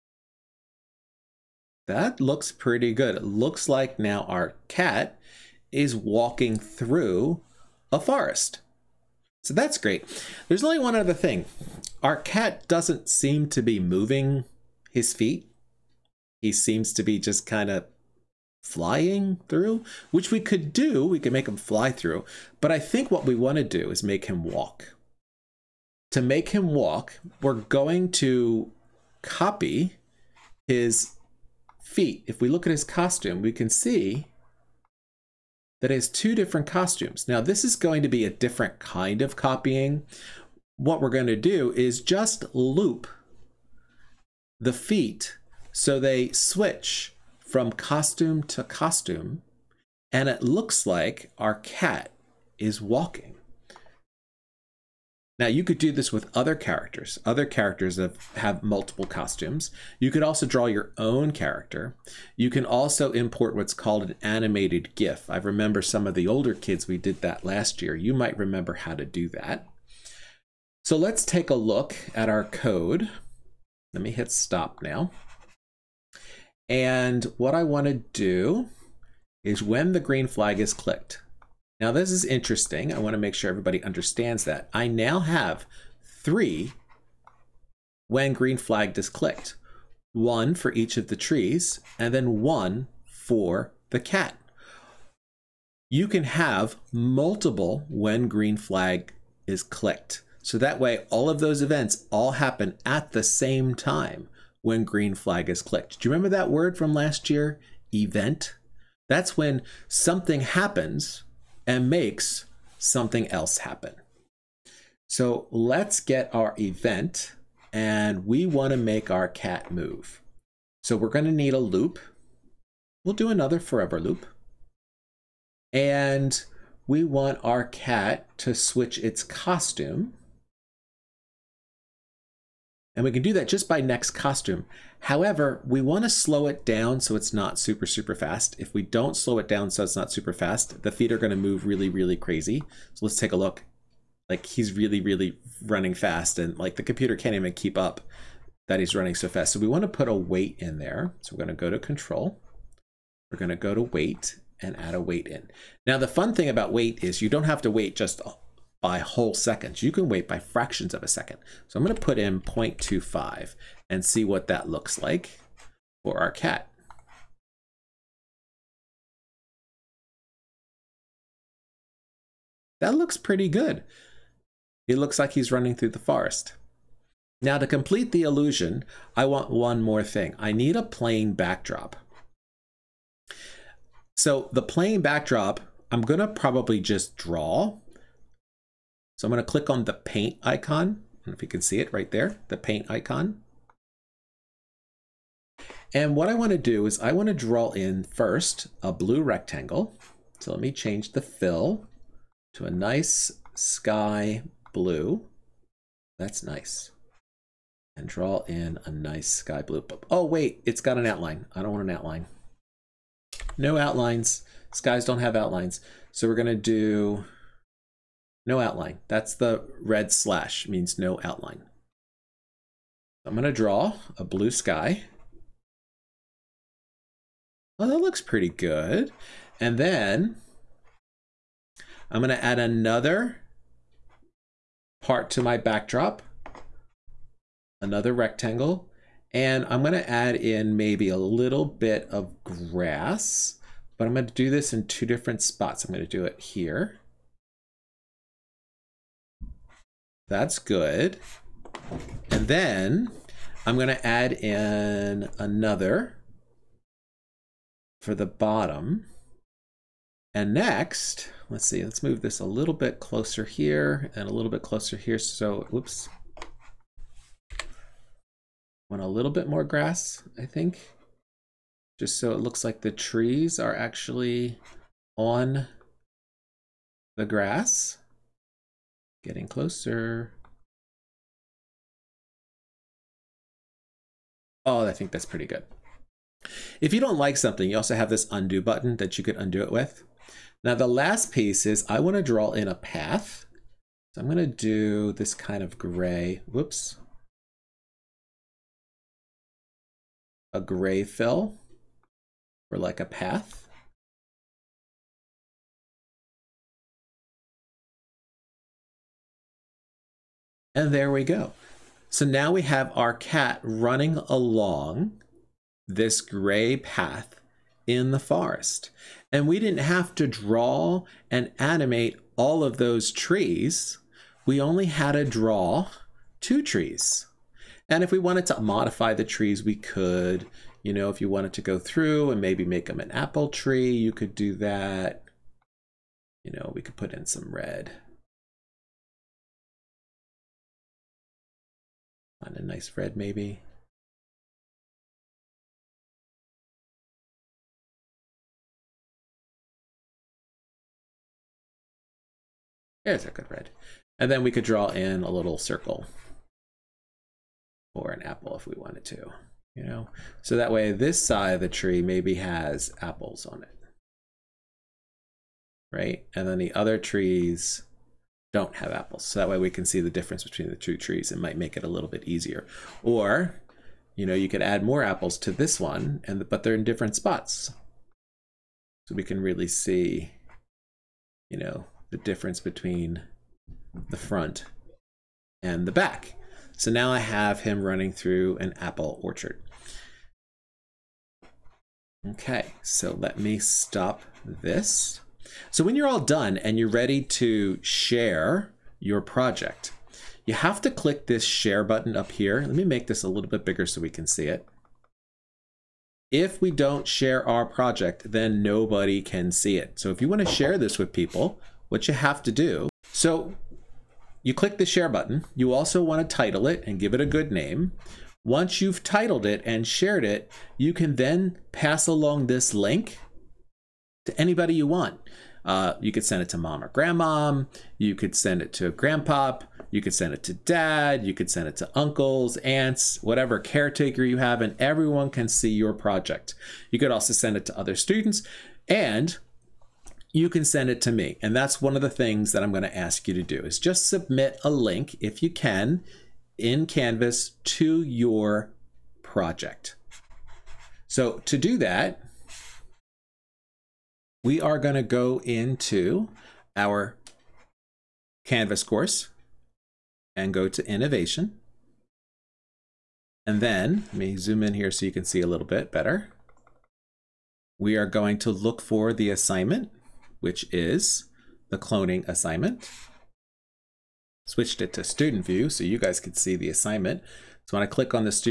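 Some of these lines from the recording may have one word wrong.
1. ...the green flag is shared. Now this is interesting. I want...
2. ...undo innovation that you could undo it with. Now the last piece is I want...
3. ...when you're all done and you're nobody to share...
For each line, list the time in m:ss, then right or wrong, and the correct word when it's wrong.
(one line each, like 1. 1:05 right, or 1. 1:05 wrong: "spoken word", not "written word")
1. 1:19 wrong: "clicked", not "shared"
2. 4:48 wrong: "button", not "innovation"
3. 6:35 wrong: "ready", not "nobody".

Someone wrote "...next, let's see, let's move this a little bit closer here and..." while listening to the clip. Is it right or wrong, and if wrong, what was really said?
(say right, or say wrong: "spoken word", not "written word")
right.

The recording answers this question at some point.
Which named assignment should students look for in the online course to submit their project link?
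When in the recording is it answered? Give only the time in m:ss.
7:51.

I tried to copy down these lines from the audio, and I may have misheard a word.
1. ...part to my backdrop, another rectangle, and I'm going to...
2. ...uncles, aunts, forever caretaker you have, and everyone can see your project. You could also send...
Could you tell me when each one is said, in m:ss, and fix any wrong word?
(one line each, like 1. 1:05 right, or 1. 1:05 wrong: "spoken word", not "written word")
1. 3:55 right
2. 7:11 wrong: "whatever", not "forever".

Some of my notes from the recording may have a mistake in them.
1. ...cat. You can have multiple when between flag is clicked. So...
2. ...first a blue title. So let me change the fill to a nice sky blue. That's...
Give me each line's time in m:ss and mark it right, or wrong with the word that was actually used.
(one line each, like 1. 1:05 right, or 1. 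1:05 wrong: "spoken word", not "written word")
1. 1:34 wrong: "green", not "between"
2. 3:18 wrong: "rectangle", not "title".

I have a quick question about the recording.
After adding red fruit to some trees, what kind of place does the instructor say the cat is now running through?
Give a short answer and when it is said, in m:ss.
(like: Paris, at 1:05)
an apple orchard, at 6:28.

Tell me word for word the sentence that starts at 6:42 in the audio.
Let me make this a little bit bigger so we can see it.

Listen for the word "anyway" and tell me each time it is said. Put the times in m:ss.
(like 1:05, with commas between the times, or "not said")
not said.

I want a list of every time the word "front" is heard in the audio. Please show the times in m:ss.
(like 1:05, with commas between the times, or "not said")
6:24.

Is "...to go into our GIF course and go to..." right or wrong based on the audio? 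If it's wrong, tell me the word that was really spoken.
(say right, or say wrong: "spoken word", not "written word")
wrong: "Canvas", not "GIF".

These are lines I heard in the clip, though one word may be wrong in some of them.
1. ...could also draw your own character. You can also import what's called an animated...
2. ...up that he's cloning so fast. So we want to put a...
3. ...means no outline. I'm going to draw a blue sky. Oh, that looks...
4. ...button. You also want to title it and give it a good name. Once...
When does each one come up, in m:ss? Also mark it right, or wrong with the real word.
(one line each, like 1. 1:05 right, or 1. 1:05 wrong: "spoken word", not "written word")
1. 1:00 right
2. 2:27 wrong: "running", not "cloning"
3. 3:40 right
4. 6:55 right.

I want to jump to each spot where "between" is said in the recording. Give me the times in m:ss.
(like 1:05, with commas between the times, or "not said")
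6:10, 6:22.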